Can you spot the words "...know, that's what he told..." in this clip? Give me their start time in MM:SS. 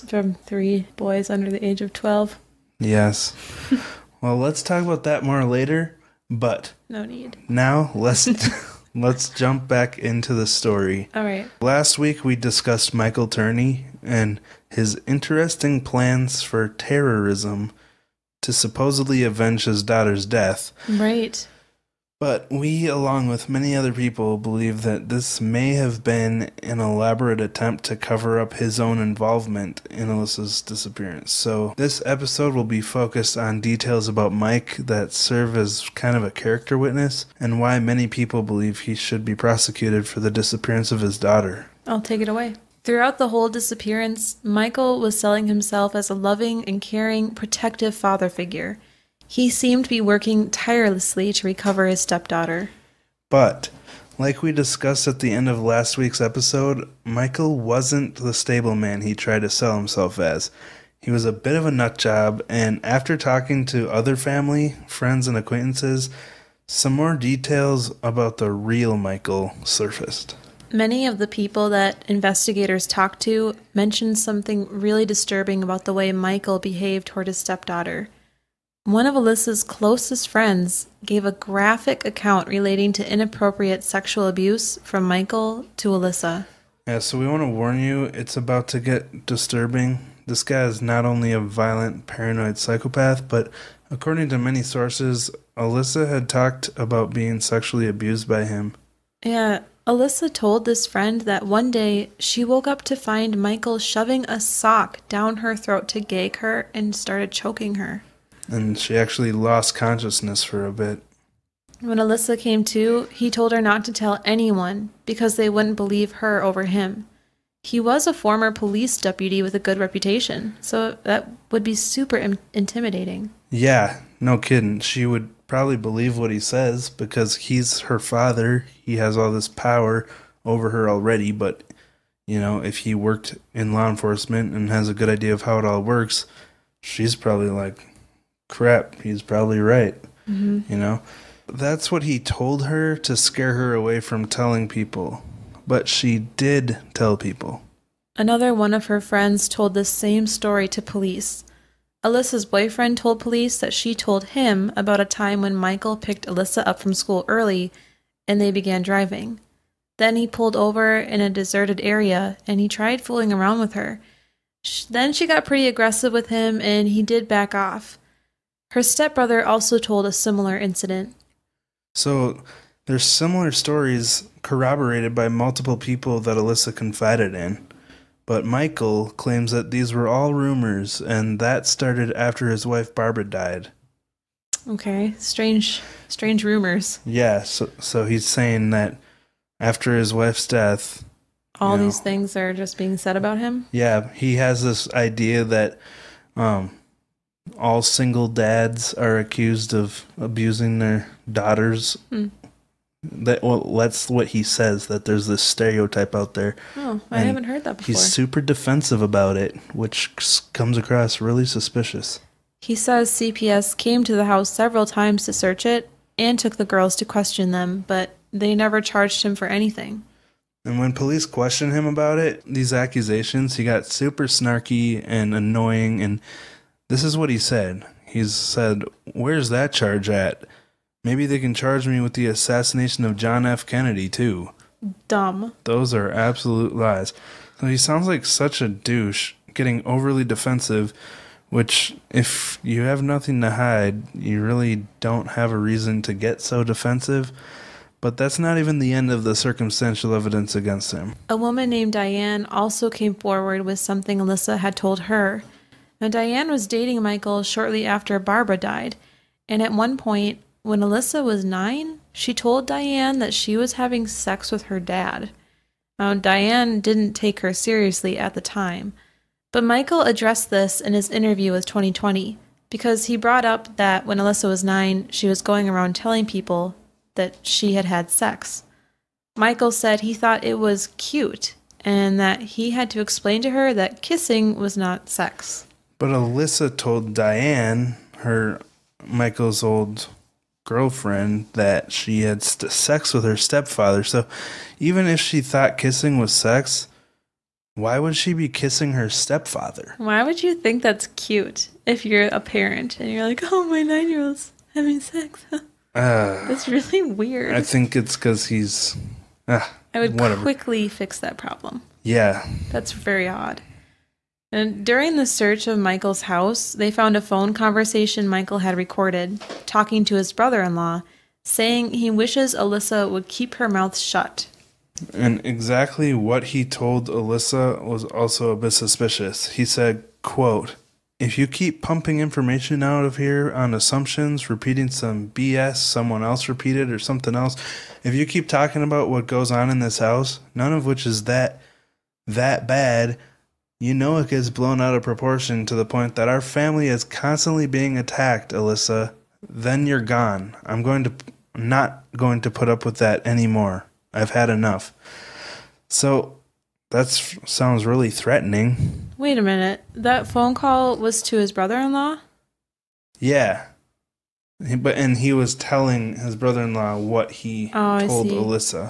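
02:20.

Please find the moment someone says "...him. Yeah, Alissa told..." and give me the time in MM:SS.
01:38.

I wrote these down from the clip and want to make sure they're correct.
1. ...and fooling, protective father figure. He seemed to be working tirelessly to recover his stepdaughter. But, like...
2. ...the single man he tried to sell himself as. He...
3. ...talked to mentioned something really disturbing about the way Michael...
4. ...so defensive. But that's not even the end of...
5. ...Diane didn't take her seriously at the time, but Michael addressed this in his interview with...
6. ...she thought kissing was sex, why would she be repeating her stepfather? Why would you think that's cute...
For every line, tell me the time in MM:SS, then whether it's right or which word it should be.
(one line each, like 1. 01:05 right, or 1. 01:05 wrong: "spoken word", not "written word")
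1. 00:46 wrong: "caring", not "fooling"
2. 00:58 wrong: "stable", not "single"
3. 01:12 right
4. 04:06 right
5. 04:26 right
6. 04:55 wrong: "kissing", not "repeating".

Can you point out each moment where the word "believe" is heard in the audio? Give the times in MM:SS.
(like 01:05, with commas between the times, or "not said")
00:24, 00:38, 01:55, 02:05.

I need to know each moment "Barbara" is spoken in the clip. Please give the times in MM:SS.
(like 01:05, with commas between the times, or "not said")
03:02, 04:18.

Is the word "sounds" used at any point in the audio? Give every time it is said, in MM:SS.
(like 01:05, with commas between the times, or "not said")
03:57, 05:57.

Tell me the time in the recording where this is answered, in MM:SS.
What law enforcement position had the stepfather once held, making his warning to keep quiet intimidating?
01:58.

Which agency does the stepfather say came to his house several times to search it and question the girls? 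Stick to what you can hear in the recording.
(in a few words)
CPS.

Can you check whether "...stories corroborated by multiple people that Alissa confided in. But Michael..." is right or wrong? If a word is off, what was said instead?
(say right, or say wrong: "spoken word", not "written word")
right.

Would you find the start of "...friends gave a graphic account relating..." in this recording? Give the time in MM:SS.
01:20.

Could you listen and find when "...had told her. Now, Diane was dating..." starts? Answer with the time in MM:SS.
04:14.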